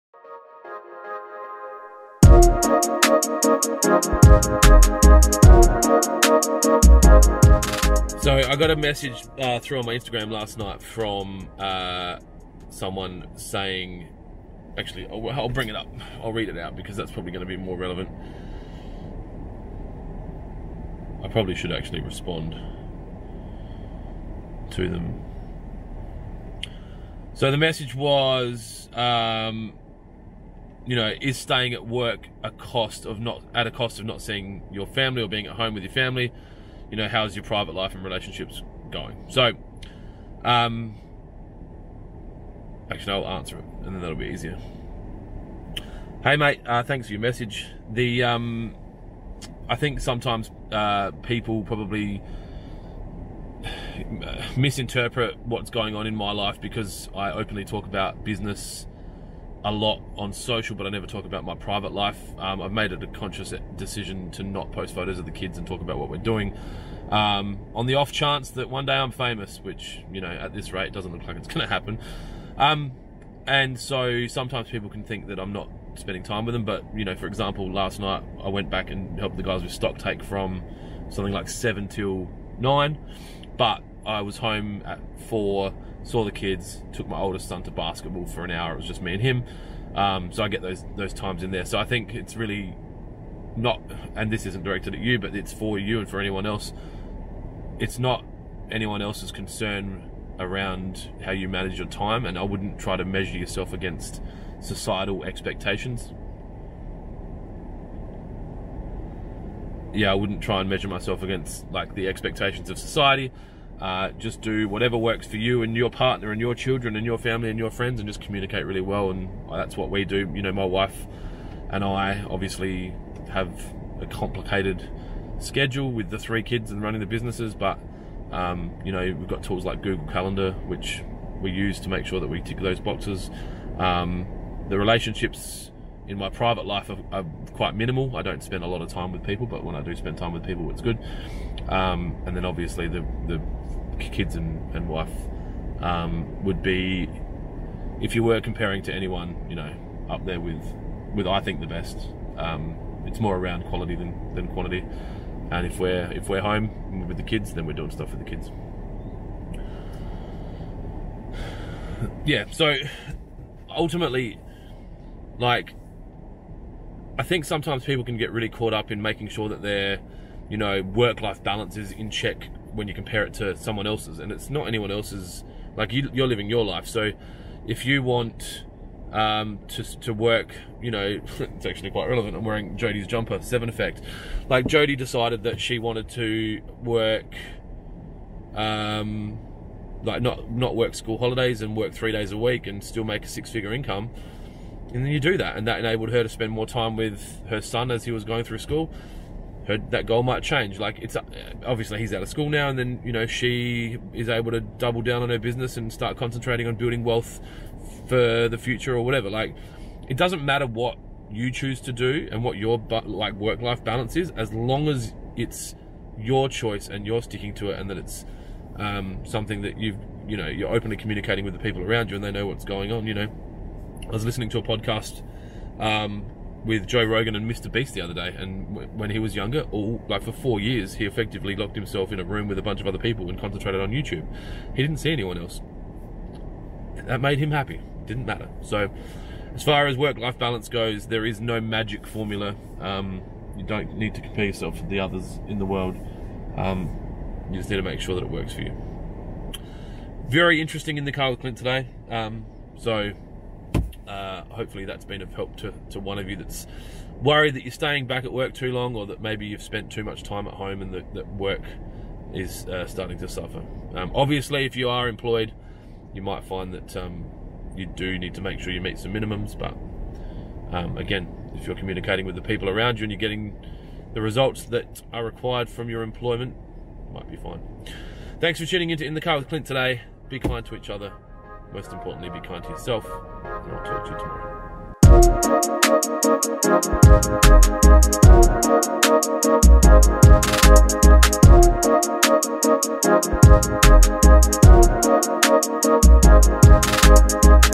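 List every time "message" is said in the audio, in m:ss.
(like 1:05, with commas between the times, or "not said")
0:08, 0:27, 0:47.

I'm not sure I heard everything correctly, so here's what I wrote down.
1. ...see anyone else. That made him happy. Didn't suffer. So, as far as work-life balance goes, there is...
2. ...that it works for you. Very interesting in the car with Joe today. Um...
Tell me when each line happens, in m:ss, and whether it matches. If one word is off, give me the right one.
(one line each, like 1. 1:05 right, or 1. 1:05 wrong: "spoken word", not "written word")
1. 3:54 wrong: "matter", not "suffer"
2. 4:08 wrong: "Clint", not "Joe".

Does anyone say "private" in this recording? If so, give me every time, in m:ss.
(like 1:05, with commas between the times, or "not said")
0:37, 1:01, 2:16.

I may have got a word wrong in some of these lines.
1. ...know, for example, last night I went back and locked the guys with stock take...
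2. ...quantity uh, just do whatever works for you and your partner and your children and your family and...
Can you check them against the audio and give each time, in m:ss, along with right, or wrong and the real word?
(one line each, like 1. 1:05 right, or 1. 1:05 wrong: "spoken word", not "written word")
1. 1:17 wrong: "helped", not "locked"
2. 1:52 wrong: "society", not "quantity".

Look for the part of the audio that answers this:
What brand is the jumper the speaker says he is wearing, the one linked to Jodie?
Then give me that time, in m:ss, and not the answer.
3:03.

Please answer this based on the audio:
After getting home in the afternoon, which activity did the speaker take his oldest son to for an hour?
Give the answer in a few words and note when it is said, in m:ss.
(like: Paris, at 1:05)
Basketball, at 1:27.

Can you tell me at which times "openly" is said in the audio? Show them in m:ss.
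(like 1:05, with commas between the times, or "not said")
0:57, 3:40.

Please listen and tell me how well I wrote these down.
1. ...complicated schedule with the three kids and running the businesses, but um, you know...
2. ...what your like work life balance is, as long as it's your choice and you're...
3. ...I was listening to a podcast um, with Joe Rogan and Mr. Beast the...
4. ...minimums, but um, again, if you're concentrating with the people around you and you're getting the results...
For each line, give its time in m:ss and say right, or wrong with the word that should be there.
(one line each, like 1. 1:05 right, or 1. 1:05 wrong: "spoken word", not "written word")
1. 2:04 right
2. 3:32 right
3. 3:44 right
4. 4:29 wrong: "communicating", not "concentrating".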